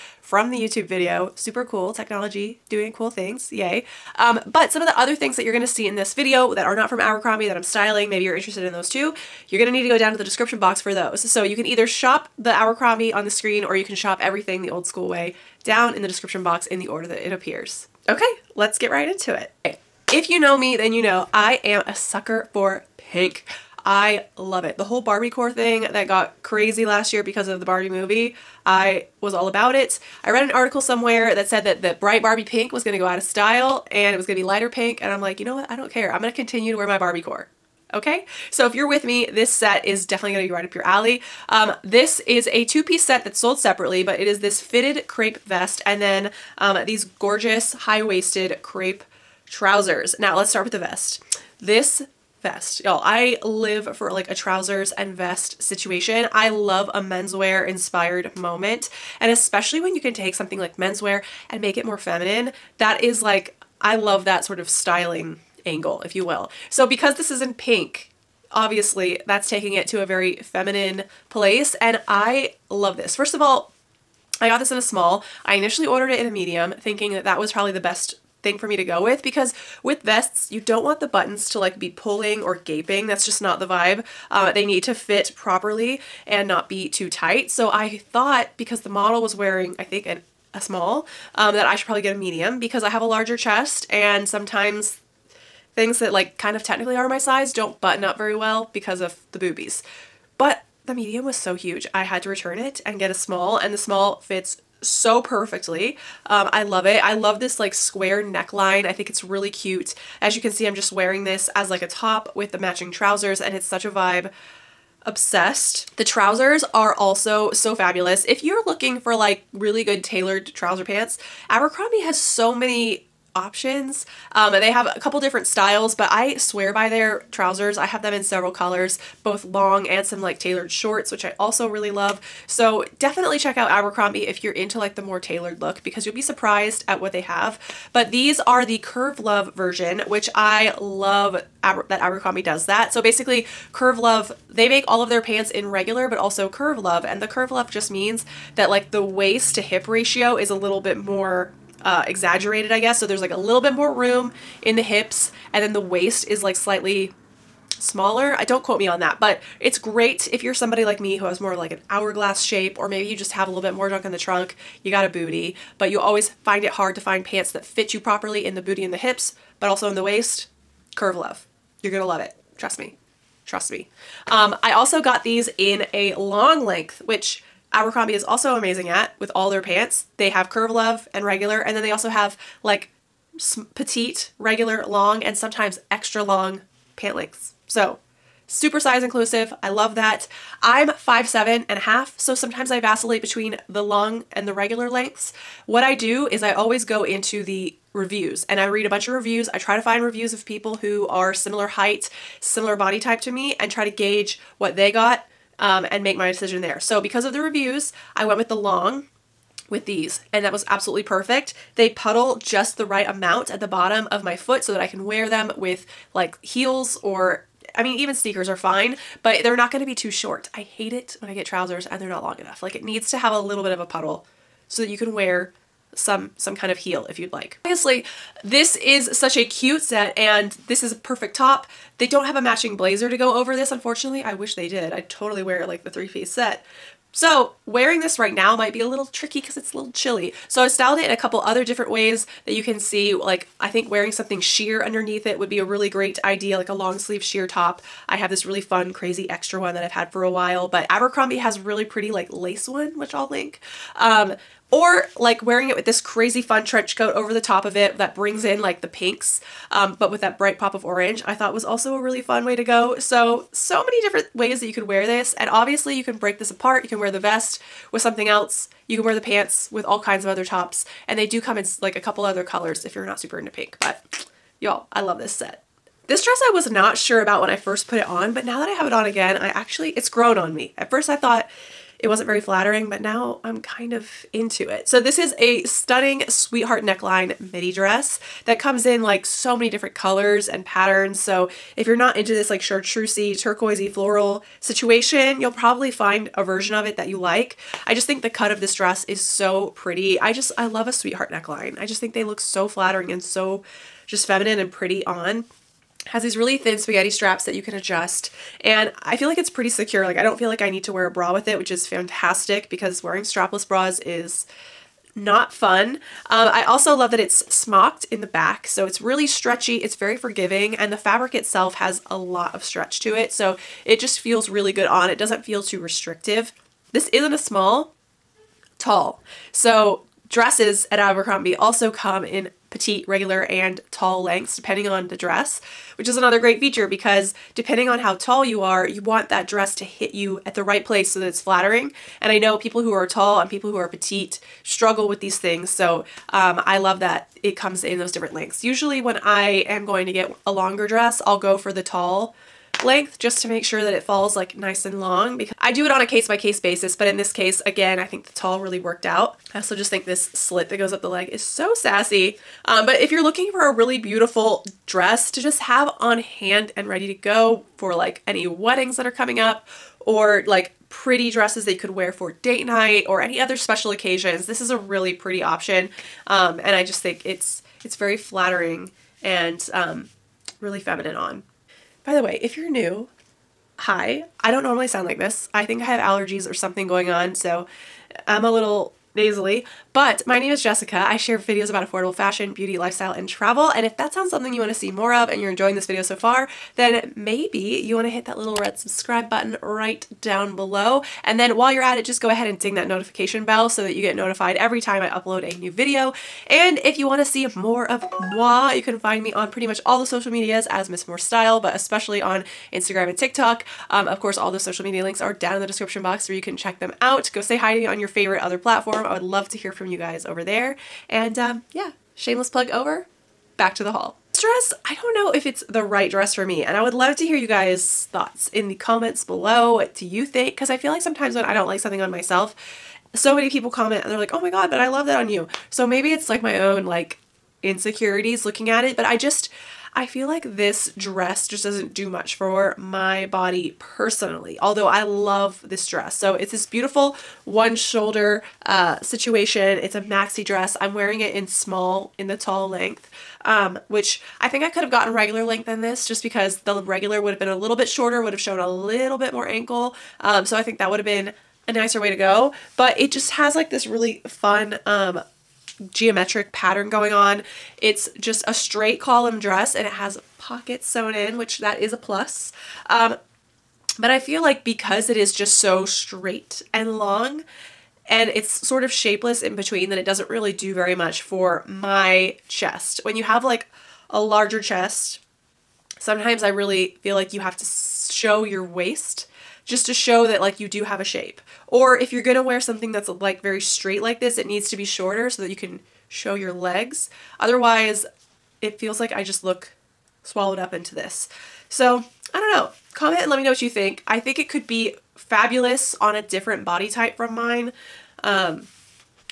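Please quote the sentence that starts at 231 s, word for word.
They don't have a matching blazer to go over this, unfortunately.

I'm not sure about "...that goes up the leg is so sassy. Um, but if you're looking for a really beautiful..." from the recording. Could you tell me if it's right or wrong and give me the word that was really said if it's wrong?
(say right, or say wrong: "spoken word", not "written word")
right.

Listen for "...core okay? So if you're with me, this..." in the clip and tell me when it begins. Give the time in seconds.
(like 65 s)
37 s.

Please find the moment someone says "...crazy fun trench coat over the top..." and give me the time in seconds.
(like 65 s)
256 s.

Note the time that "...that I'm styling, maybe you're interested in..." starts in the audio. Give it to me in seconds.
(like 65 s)
7 s.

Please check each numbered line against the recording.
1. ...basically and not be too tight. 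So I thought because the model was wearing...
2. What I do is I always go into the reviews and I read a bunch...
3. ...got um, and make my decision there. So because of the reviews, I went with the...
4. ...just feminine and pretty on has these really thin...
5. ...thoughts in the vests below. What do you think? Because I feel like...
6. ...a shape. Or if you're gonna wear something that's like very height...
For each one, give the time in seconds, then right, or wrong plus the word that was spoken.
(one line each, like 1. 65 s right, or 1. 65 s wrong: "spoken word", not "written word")
1. 85 s wrong: "properly", not "basically"
2. 195 s right
3. 204 s right
4. 304 s right
5. 428 s wrong: "comments", not "vests"
6. 490 s wrong: "straight", not "height".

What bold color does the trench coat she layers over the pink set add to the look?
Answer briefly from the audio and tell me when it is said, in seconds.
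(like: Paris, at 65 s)
Orange, at 260 s.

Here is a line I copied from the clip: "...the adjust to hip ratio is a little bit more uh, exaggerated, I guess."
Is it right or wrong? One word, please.
wrong.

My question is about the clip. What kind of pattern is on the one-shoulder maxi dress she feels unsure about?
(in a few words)
Geometric.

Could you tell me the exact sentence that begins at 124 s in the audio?
Um, they have a couple different styles, but I swear by their trousers.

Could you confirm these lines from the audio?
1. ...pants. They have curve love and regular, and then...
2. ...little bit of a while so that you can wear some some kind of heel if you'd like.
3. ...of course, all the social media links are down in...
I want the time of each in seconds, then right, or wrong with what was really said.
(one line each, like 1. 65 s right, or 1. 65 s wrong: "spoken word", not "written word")
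1. 179 s right
2. 223 s wrong: "puddle", not "while"
3. 414 s right.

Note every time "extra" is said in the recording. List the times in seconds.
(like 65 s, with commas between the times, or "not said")
185 s, 249 s.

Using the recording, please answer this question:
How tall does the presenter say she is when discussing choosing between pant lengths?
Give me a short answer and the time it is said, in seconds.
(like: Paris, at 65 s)
5'7.5", at 190 s.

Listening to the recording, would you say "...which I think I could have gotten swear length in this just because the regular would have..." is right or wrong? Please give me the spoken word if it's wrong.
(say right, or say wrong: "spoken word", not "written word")
wrong: "regular", not "swear".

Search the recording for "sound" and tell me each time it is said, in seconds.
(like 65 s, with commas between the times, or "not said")
384 s, 394 s.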